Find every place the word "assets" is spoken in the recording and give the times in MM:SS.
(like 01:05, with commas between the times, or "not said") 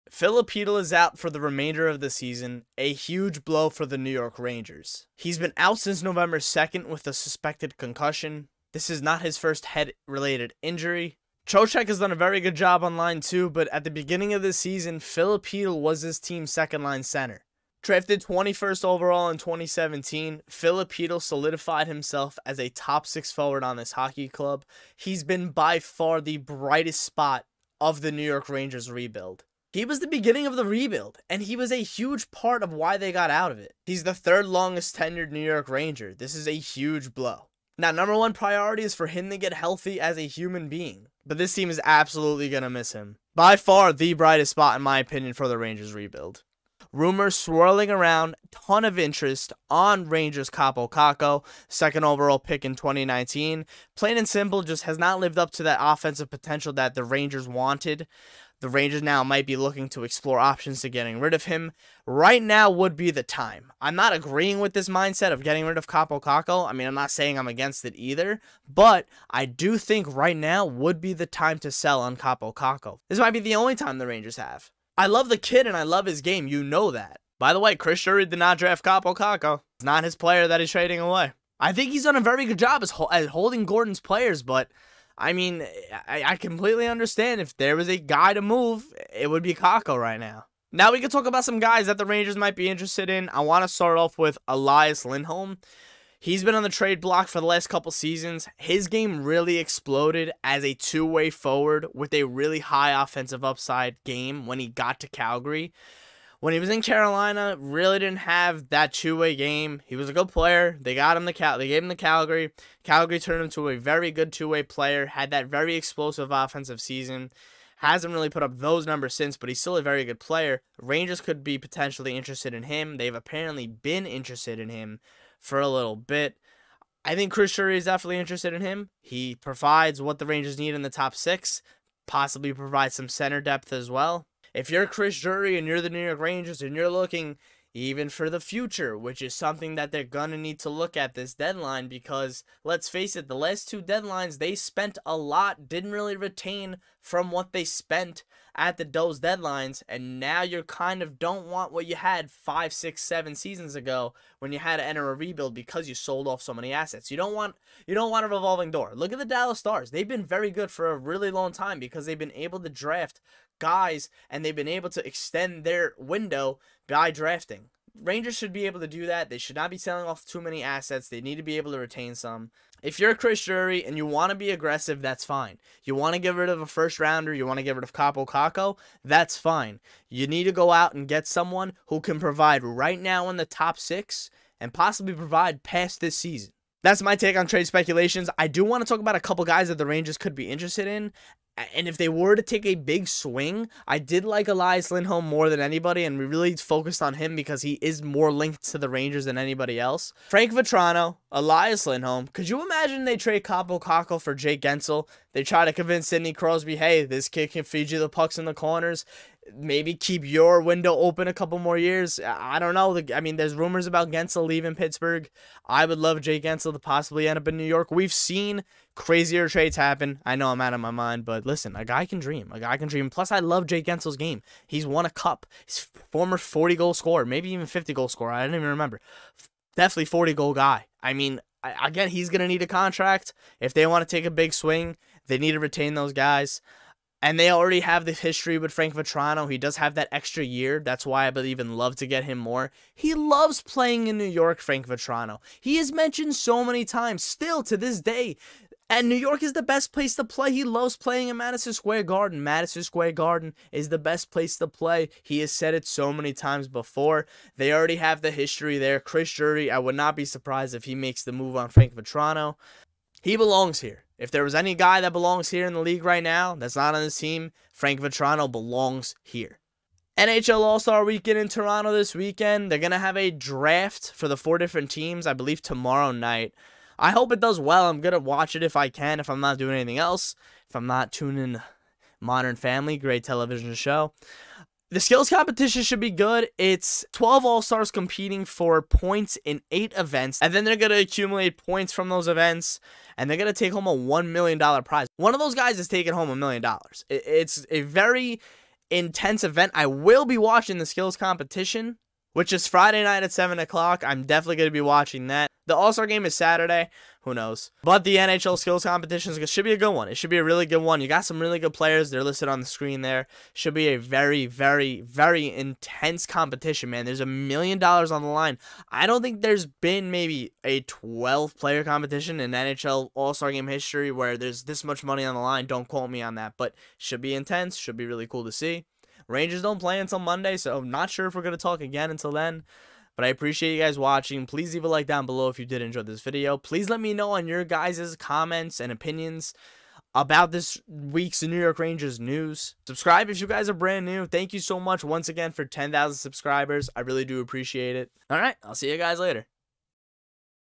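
02:36, 02:50.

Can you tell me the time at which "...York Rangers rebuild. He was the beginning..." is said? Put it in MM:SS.
00:28.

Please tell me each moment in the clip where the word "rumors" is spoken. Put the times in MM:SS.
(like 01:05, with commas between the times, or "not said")
00:46, 03:33.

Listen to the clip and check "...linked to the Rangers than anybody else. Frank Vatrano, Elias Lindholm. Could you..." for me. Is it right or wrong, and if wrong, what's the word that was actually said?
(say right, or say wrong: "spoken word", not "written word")
right.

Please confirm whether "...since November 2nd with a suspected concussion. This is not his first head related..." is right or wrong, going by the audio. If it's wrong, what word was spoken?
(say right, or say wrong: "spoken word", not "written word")
right.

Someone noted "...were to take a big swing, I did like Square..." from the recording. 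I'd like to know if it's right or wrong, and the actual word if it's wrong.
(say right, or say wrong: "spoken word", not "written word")
wrong: "Elias", not "Square".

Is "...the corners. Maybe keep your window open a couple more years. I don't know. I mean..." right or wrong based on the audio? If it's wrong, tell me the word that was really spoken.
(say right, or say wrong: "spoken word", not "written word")
right.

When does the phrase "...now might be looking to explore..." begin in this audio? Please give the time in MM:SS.
00:59.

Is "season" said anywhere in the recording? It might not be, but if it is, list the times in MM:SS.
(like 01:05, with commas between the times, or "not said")
00:02, 00:14, 01:37, 01:56, 02:33, 03:06.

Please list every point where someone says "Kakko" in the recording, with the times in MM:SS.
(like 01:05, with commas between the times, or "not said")
00:50, 01:06, 01:12, 01:19, 01:29, 02:58.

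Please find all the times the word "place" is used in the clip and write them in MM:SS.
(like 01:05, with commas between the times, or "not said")
04:09, 04:14.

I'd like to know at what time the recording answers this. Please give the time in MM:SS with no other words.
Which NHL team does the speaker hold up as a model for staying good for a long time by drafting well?
02:39.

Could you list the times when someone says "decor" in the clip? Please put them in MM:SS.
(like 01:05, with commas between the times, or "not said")
not said.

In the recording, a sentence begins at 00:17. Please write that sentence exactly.
Drafted 21st overall in 2017, Filip Chytil solidified himself as a top six forward on this hockey club.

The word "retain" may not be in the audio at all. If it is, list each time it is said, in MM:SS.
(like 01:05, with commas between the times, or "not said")
02:26, 02:51, 03:55.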